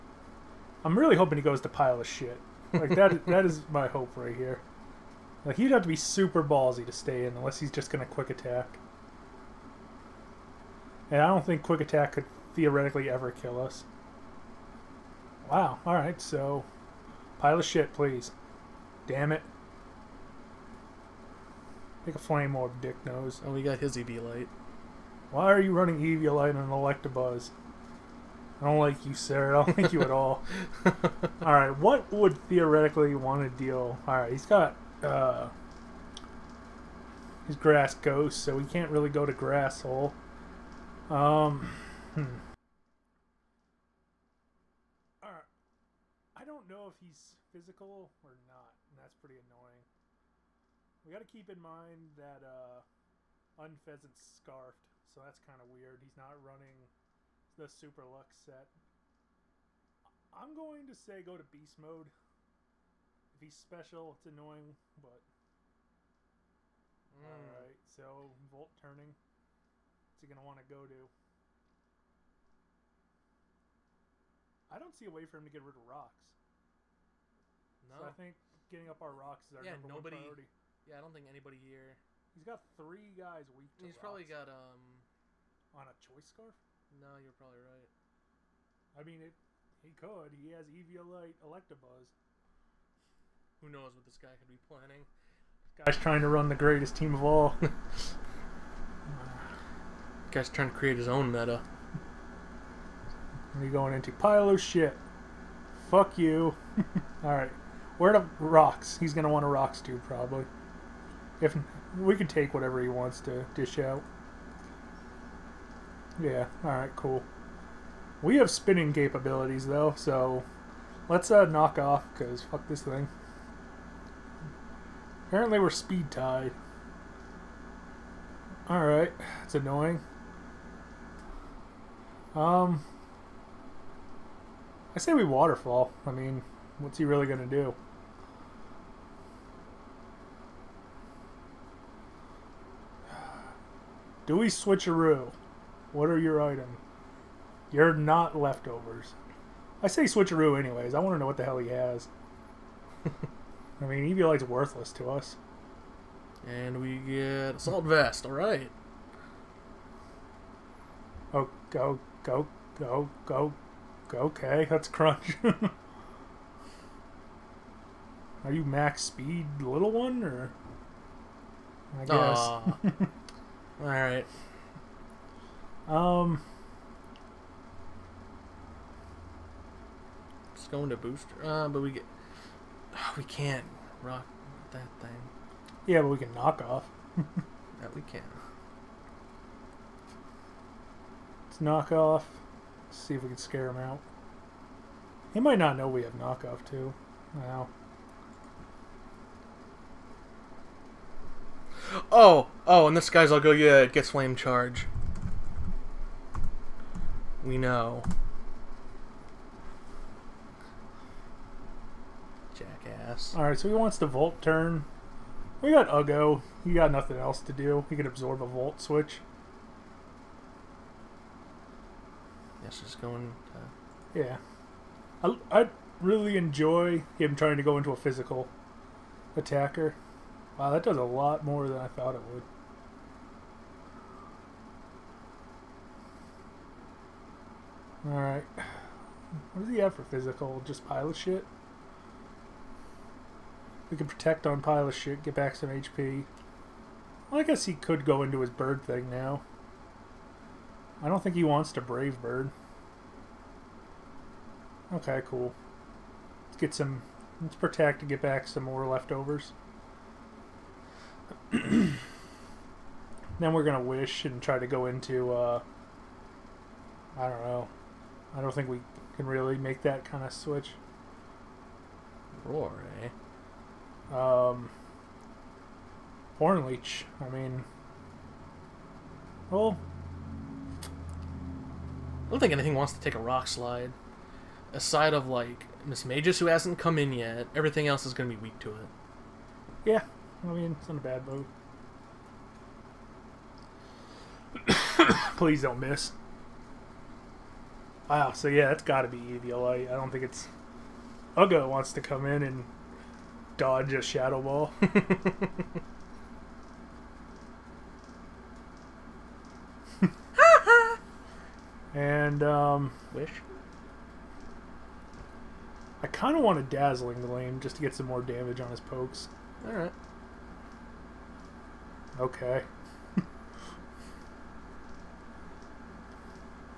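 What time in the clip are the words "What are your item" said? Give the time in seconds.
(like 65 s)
145 s.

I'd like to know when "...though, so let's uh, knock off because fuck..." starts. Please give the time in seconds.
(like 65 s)
119 s.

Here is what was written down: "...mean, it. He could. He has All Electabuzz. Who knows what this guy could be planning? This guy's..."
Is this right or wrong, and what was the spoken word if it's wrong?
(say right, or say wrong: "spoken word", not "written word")
wrong: "Eviolite", not "All".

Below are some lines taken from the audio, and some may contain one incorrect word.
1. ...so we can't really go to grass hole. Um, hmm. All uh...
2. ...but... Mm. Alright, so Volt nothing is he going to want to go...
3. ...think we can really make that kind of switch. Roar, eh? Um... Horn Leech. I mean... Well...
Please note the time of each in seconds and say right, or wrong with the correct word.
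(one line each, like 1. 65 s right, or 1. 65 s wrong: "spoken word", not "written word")
1. 38 s right
2. 64 s wrong: "turning", not "nothing"
3. 268 s right.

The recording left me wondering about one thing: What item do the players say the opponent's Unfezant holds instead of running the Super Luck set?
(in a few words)
Choice scarf.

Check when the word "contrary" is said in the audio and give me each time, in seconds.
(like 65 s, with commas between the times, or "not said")
not said.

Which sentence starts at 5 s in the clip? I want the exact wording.
Like he'd have to be super ballsy to stay in, unless he's just gonna quick attack.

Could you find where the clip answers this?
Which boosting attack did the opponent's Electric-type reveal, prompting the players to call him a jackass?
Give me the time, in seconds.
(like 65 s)
204 s.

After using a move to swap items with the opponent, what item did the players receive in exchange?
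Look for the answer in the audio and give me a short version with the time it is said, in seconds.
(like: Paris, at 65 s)
Assault Vest, at 157 s.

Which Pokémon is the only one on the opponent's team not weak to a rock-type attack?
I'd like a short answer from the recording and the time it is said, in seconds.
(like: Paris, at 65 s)
Mismagius, at 285 s.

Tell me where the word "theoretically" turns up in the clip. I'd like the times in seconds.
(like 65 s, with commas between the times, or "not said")
12 s, 32 s.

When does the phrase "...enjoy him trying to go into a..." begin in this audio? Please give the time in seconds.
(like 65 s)
226 s.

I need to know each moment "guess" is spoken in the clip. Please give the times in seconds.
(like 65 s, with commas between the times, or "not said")
172 s, 222 s, 247 s.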